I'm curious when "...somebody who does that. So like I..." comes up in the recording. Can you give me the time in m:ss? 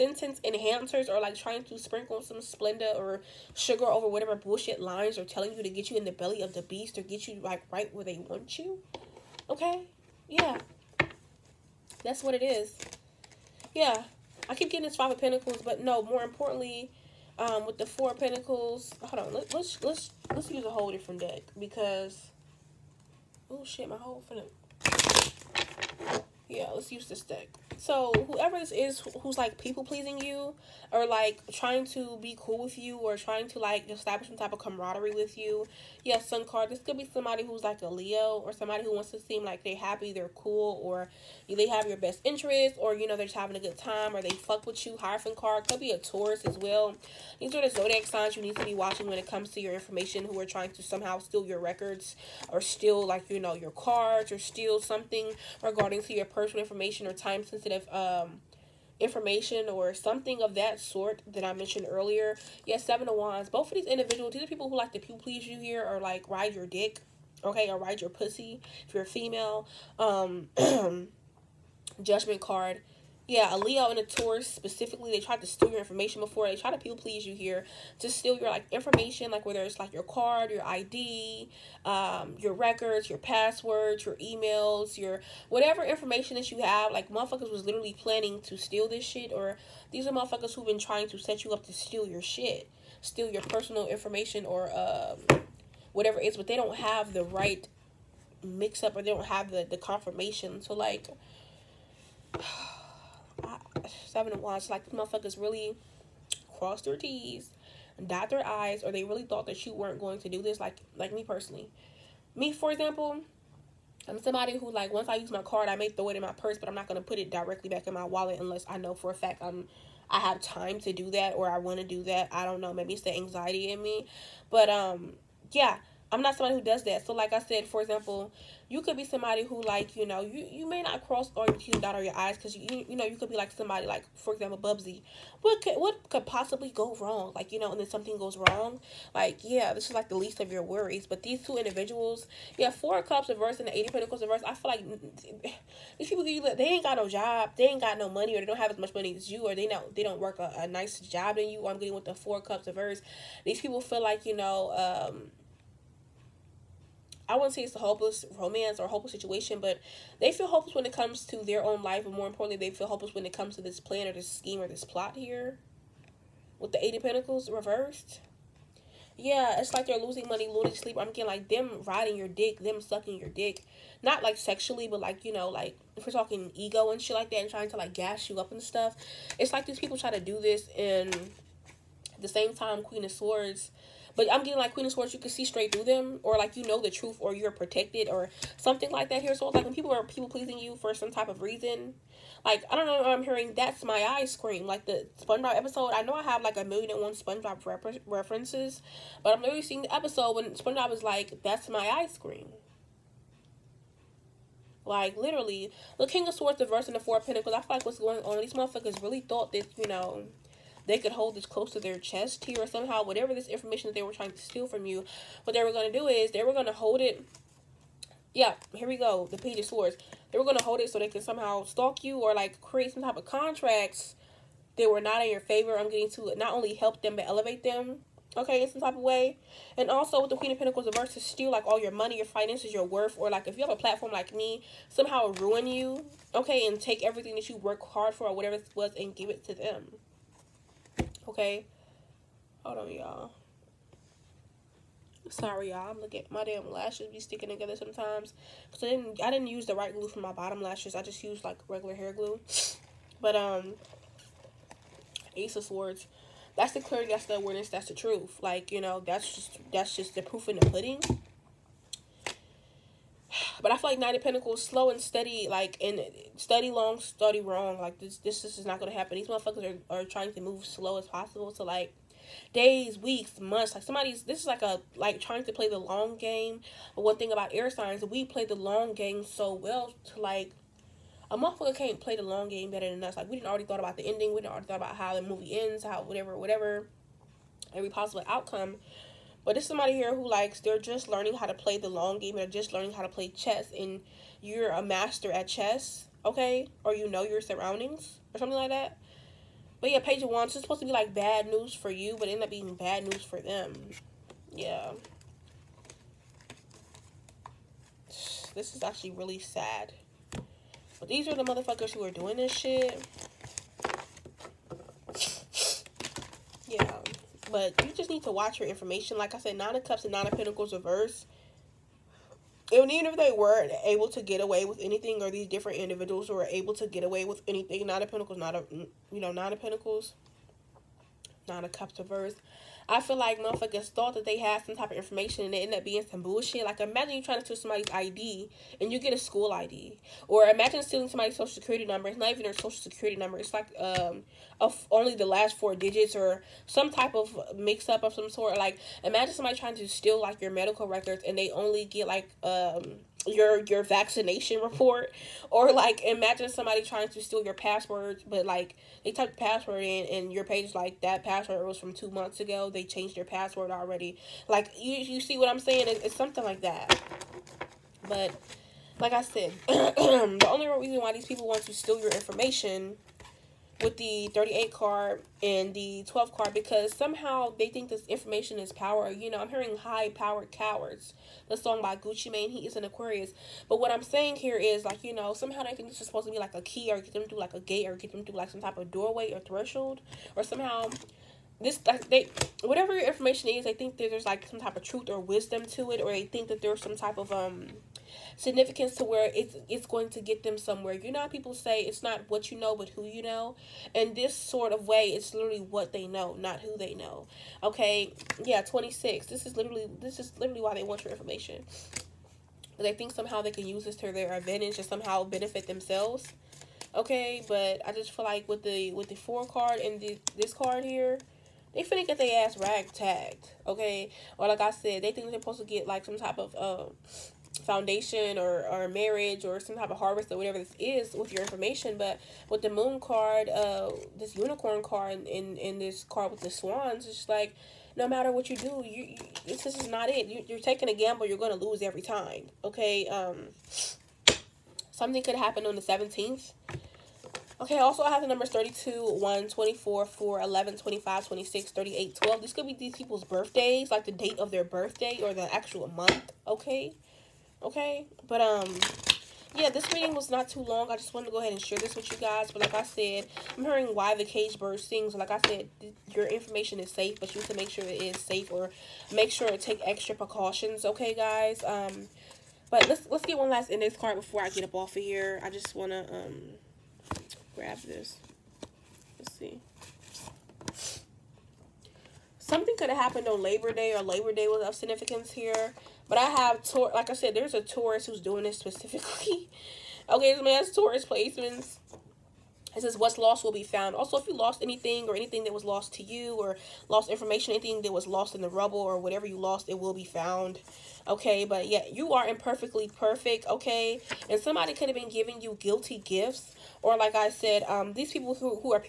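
2:06.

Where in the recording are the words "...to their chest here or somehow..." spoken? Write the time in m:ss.
3:31.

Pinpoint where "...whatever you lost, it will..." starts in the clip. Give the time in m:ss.
8:18.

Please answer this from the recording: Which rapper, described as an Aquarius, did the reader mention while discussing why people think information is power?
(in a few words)
Gucci Mane.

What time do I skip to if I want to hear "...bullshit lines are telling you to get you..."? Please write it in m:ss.
0:04.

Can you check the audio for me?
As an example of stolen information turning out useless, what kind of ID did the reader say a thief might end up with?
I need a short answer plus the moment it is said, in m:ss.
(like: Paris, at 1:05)
School ID, at 5:39.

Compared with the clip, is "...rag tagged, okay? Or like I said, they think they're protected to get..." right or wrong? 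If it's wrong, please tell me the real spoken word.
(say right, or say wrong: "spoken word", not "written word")
wrong: "supposed", not "protected".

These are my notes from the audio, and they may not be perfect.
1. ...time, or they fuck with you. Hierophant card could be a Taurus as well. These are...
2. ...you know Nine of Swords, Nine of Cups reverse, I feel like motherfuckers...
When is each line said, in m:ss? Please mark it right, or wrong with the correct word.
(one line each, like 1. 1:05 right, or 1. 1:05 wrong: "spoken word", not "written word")
1. 0:43 right
2. 5:28 wrong: "Pentacles", not "Swords".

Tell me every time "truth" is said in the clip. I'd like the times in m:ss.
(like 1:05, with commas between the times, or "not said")
3:06, 4:17, 6:34.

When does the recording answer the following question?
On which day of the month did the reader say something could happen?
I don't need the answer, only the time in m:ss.
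7:25.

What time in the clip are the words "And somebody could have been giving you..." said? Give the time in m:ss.
8:24.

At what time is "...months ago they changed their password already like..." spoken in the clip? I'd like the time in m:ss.
6:02.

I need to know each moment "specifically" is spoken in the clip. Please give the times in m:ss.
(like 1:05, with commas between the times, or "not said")
1:14, 8:08.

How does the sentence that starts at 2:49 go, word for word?
Yeah, it's like they're losing money, losing sleep.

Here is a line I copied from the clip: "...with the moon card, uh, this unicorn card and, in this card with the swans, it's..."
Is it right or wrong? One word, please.
right.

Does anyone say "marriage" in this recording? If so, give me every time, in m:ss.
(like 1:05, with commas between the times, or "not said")
7:08.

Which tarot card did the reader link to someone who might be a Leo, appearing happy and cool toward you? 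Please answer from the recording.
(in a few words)
Sun card.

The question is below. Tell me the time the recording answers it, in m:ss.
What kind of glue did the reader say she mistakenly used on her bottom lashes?
4:11.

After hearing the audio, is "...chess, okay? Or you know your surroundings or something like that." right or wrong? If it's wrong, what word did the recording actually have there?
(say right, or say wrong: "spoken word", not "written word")
right.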